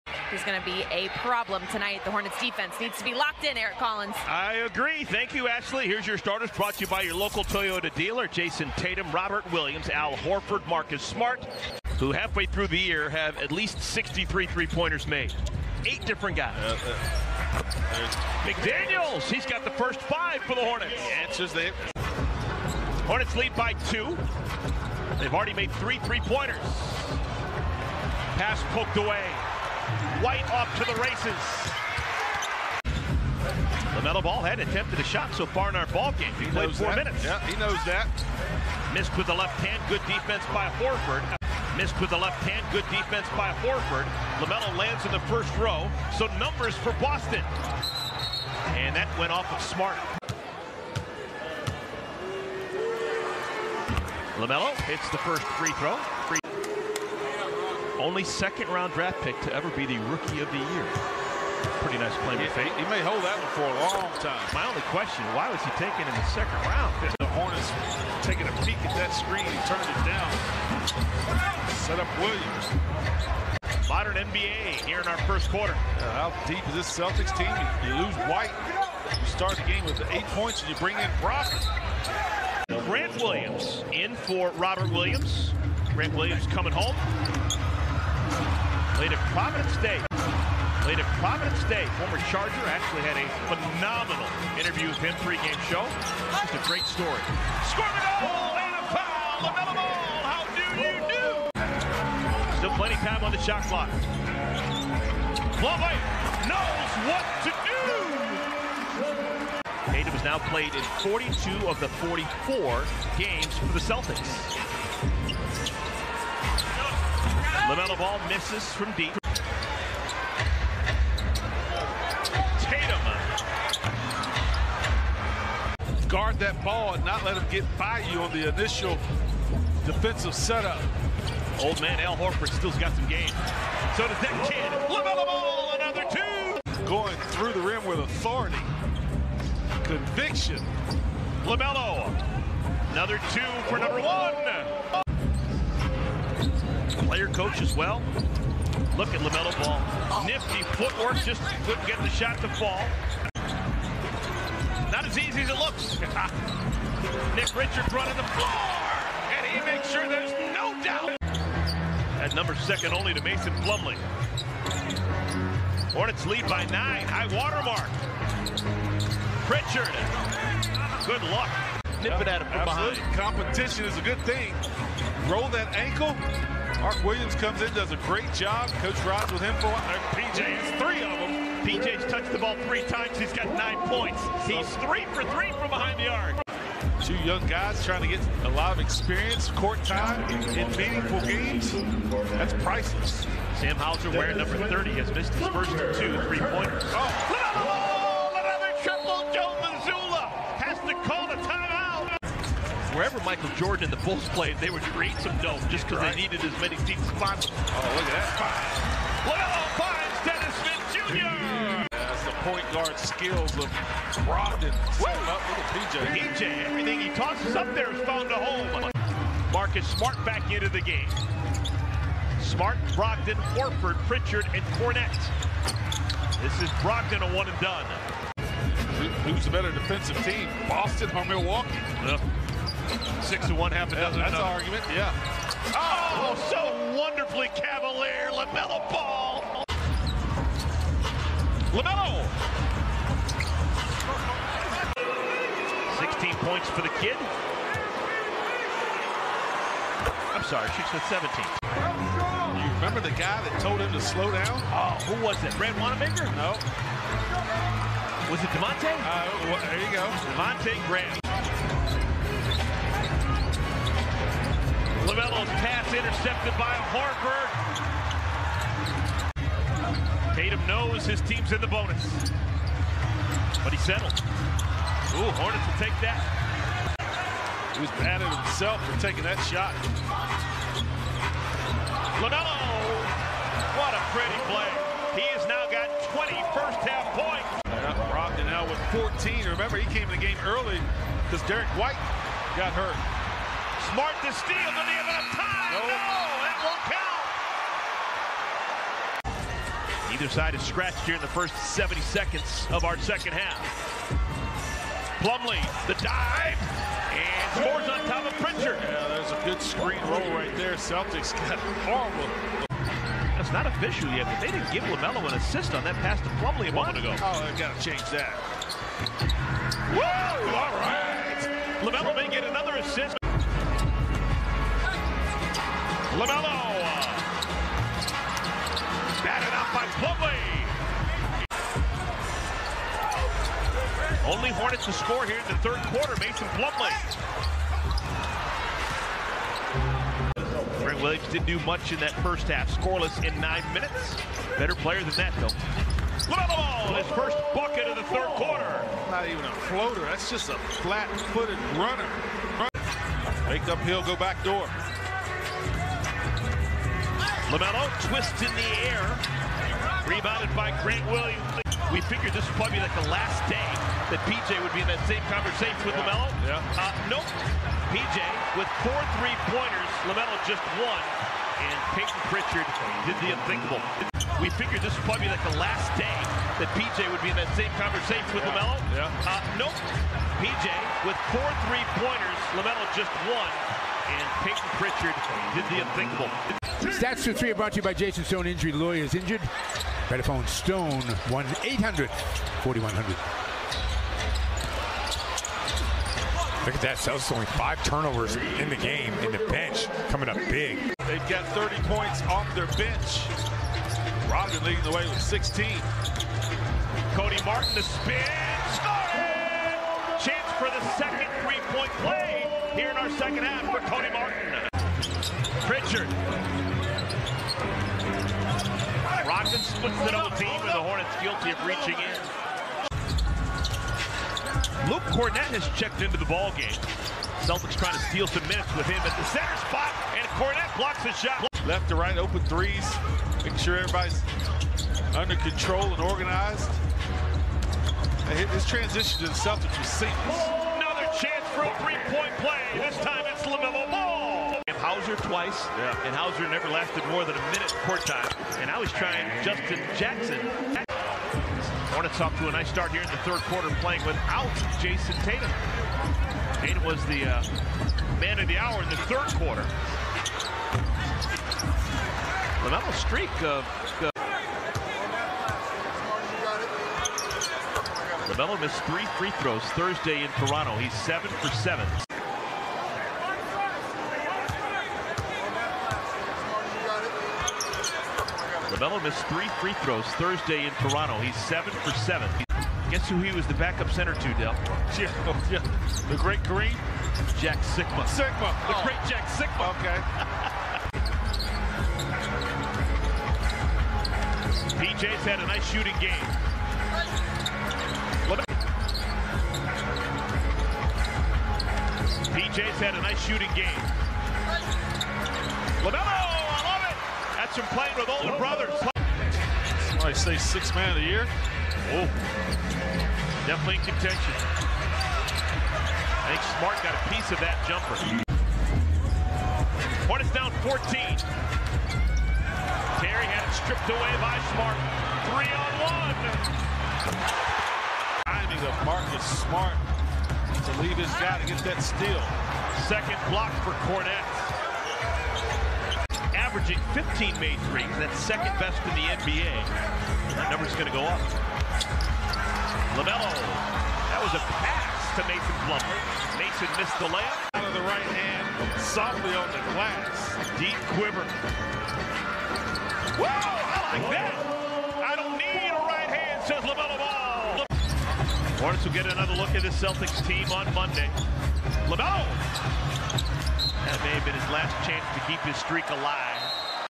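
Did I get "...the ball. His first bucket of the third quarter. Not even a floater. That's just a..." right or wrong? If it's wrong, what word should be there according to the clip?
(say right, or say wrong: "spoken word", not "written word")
right.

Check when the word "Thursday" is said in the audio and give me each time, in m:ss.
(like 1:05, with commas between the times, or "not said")
7:49, 8:00.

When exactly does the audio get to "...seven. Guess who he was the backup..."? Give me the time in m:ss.
8:01.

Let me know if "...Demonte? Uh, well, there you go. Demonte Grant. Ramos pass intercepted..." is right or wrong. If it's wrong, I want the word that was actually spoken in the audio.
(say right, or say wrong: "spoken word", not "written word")
right.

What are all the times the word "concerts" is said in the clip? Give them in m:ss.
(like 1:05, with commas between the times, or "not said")
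not said.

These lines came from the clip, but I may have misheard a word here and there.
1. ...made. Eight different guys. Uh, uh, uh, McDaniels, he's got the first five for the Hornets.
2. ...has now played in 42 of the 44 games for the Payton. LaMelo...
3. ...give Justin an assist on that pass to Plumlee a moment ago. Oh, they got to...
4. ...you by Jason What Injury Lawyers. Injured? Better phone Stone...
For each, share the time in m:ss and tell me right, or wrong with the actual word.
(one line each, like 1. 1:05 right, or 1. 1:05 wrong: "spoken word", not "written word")
1. 0:15 right
2. 1:50 wrong: "Celtics", not "Payton"
3. 5:14 wrong: "LaMelo", not "Justin"
4. 6:27 wrong: "Stone", not "What".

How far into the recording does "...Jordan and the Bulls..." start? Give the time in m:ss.
3:23.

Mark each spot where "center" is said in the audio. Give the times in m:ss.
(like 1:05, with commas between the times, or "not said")
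7:09, 8:03.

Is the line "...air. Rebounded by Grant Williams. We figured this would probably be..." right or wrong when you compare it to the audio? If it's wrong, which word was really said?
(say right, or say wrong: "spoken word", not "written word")
right.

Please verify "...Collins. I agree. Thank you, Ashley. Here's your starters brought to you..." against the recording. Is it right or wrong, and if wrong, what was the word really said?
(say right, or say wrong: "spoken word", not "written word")
right.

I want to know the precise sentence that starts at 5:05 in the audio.
Plumlee, the dive, and scores on top of Pritchard.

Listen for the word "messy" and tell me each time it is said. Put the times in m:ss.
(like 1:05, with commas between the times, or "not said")
not said.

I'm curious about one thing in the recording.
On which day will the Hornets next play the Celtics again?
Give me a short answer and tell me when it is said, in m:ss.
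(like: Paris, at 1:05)
Monday, at 9:20.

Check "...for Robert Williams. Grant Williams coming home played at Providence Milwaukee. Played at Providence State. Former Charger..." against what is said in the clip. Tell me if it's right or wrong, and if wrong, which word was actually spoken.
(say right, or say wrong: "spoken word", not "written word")
wrong: "State", not "Milwaukee".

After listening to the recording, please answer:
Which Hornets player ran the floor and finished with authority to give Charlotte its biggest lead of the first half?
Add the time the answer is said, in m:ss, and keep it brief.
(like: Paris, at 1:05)
Nick Richards, at 2:37.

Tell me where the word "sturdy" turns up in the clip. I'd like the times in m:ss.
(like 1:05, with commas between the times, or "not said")
not said.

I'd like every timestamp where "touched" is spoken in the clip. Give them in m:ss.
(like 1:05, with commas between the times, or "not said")
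3:02.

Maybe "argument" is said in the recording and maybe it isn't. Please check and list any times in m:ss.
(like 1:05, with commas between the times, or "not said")
3:54.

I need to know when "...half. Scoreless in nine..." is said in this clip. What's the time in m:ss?
5:42.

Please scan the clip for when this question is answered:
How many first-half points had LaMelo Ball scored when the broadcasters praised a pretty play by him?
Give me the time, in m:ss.
4:46.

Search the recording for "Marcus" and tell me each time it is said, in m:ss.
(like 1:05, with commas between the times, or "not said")
0:10, 3:39, 8:48.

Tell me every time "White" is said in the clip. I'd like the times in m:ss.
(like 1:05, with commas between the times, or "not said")
0:30, 1:18, 4:51.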